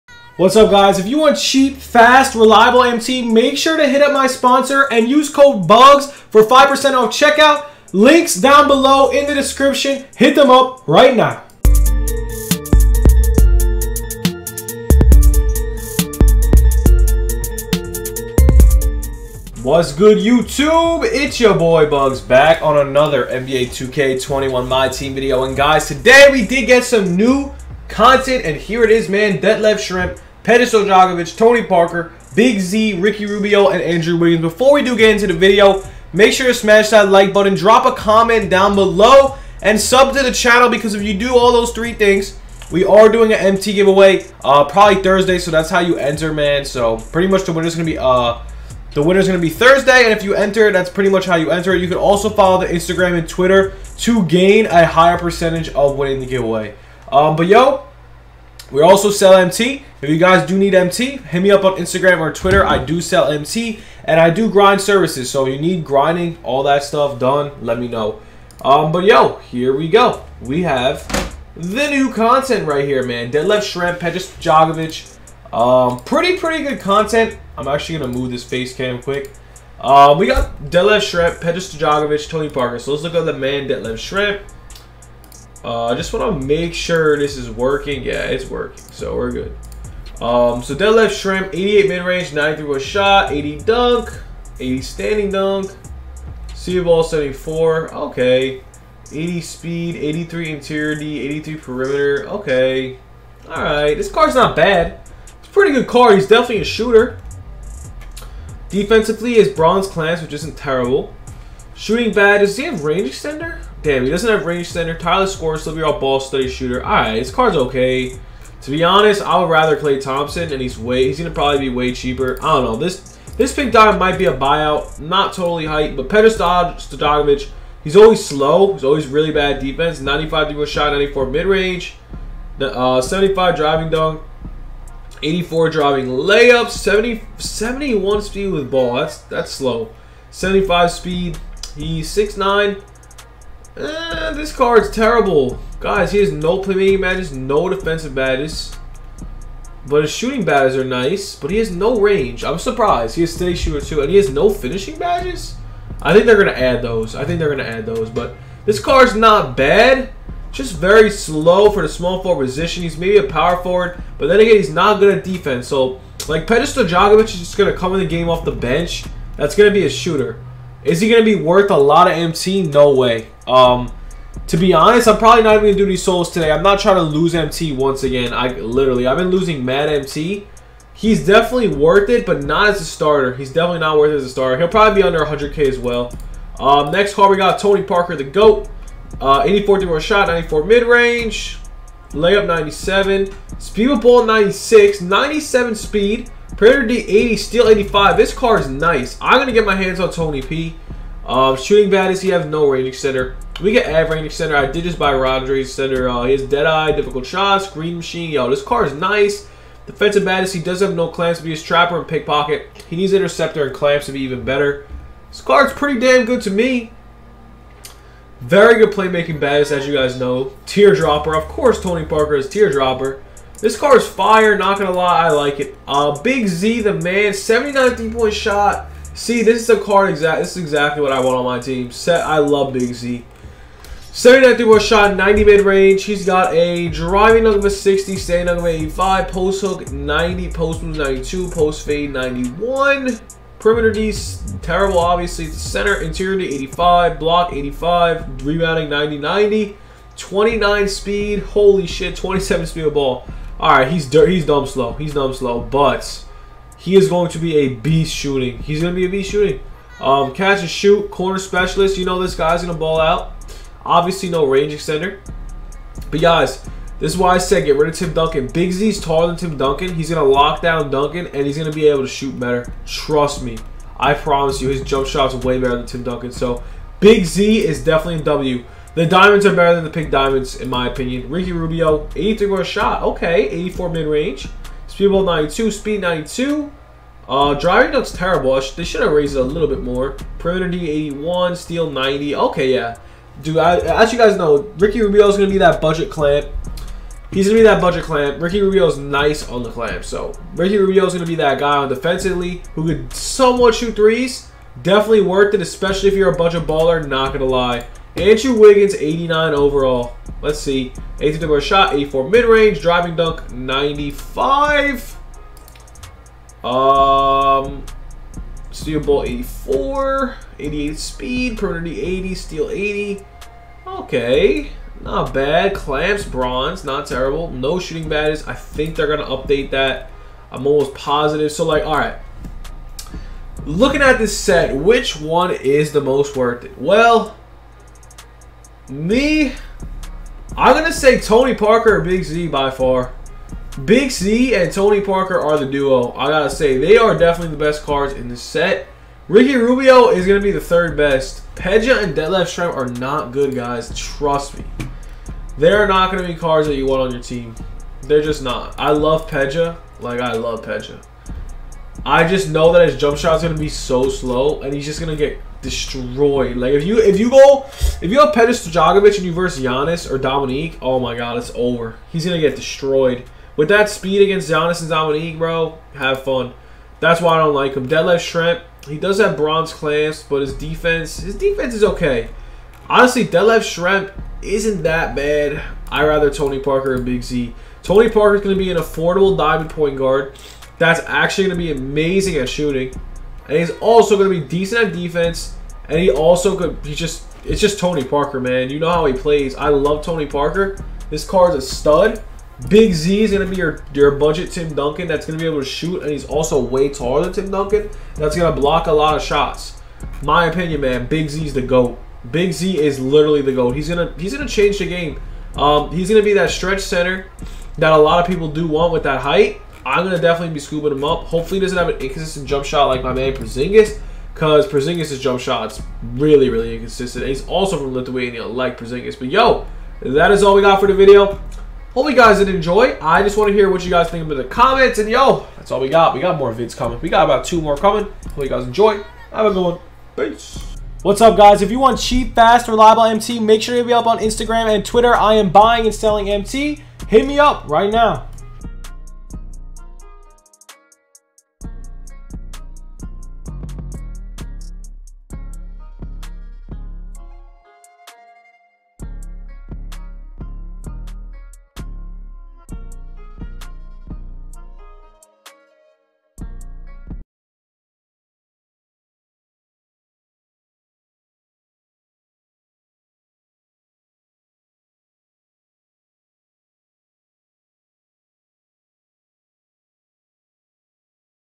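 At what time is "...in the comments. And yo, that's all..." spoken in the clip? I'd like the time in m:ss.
7:14.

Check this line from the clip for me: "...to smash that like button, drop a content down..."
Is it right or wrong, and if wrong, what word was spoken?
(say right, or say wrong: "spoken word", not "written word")
wrong: "comment", not "content".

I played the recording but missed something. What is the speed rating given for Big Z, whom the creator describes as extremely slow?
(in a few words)
29.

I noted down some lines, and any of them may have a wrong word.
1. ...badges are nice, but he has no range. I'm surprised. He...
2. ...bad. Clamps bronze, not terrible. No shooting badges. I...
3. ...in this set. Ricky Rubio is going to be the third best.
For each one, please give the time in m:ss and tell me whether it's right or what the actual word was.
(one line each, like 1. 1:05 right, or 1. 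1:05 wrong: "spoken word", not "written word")
1. 2:30 right
2. 5:25 right
3. 5:48 right.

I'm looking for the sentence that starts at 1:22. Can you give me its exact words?
So let's look at the man Detlef Schrempf.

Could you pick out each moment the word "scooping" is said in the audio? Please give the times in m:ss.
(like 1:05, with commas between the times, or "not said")
7:00.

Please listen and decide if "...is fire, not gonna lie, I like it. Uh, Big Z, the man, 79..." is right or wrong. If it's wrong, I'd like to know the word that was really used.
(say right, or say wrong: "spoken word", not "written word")
right.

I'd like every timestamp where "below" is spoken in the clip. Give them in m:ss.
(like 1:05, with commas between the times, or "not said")
0:08, 0:38.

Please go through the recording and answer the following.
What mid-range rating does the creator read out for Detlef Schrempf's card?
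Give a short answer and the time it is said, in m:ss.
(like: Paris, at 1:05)
88, at 1:31.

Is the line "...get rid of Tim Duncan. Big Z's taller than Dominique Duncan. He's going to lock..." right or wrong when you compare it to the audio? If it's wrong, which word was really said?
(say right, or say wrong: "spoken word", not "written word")
wrong: "Tim", not "Dominique".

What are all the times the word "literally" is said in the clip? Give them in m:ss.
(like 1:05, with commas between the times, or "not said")
2:58, 6:52.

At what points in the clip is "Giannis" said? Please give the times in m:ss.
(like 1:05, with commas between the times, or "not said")
6:09, 6:14.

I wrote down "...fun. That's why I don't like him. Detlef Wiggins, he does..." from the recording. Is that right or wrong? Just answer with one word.
wrong.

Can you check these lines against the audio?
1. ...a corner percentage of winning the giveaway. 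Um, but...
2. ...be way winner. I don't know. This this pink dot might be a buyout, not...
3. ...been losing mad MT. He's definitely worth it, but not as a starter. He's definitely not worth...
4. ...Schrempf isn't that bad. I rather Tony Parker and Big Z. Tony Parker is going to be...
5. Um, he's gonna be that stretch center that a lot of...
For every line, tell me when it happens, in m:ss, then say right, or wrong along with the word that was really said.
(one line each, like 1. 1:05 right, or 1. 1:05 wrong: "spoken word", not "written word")
1. 0:54 wrong: "higher", not "corner"
2. 2:01 wrong: "cheaper", not "winner"
3. 2:59 right
4. 6:23 right
5. 6:55 right.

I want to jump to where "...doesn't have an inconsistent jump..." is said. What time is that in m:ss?
7:01.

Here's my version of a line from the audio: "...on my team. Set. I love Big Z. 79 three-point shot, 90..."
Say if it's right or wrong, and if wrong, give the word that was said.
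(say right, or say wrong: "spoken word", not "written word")
right.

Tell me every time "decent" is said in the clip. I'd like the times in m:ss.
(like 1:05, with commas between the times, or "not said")
6:34.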